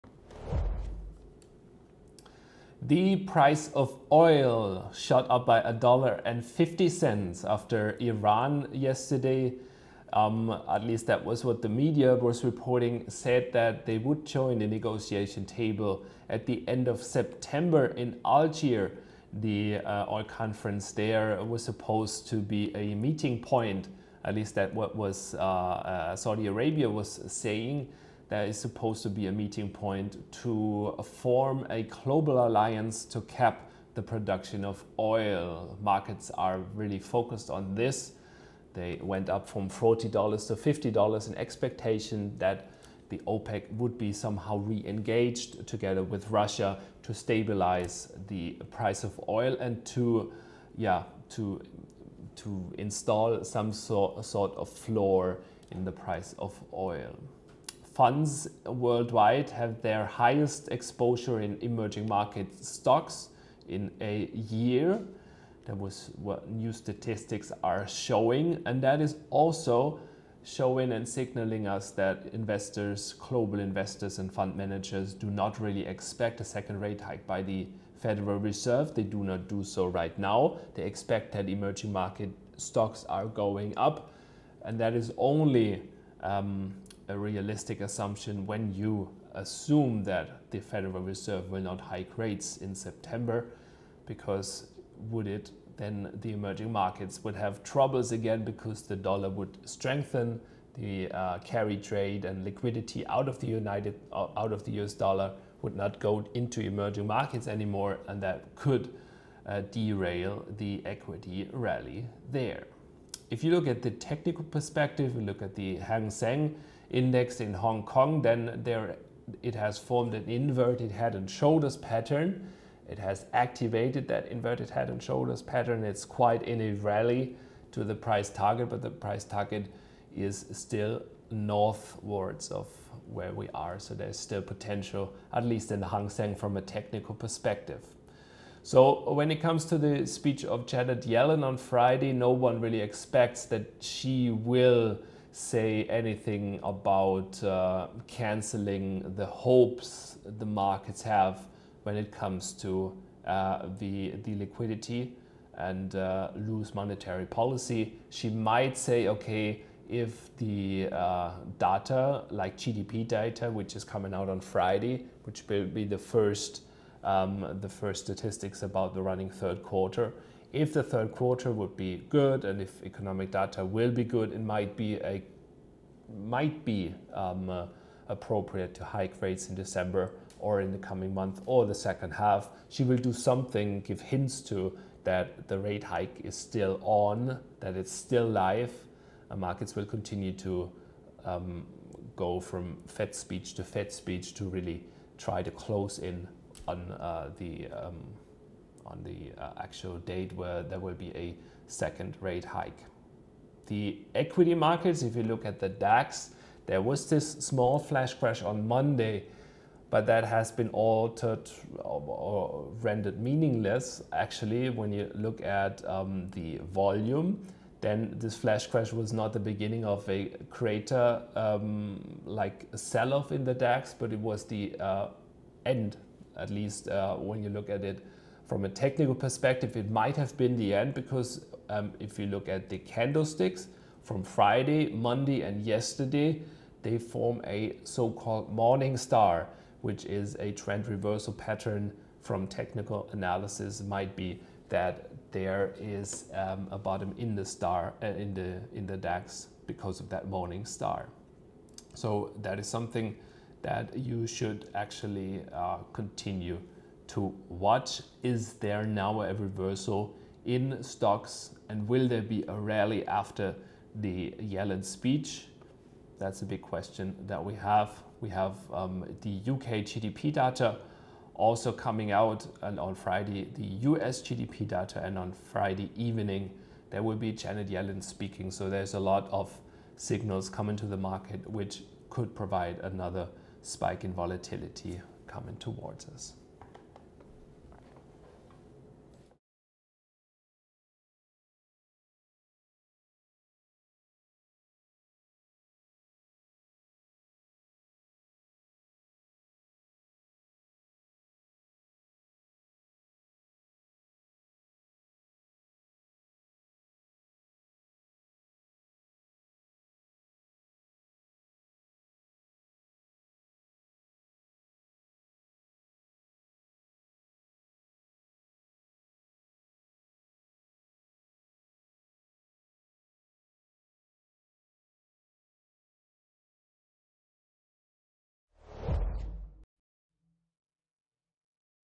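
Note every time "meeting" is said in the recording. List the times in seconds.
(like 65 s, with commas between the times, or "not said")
22 s, 29 s.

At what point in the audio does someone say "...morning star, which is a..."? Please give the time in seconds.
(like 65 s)
238 s.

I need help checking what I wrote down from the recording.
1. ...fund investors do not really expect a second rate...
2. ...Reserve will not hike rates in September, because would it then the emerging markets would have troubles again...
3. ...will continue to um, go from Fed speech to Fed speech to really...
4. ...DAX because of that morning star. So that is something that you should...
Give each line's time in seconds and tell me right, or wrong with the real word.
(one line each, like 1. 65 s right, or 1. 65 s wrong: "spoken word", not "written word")
1. 74 s wrong: "managers", not "investors"
2. 91 s right
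3. 189 s right
4. 248 s right.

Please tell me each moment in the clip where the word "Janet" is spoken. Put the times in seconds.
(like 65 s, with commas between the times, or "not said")
140 s, 277 s.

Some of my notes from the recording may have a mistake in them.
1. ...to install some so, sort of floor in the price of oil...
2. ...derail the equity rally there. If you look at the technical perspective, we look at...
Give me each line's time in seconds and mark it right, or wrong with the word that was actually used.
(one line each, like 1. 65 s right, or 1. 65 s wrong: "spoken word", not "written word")
1. 52 s right
2. 109 s right.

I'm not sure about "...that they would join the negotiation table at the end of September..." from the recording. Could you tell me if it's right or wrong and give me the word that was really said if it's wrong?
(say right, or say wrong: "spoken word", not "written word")
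right.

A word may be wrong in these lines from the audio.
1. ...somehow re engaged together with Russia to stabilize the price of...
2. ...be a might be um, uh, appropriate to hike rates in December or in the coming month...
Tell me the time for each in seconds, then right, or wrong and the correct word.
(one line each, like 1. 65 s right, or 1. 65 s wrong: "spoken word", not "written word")
1. 44 s right
2. 174 s right.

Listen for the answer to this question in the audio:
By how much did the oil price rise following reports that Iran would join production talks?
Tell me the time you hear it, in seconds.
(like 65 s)
5 s.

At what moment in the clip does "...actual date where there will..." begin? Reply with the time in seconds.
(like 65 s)
199 s.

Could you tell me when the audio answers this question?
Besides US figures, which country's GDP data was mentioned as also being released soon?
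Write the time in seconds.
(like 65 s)
269 s.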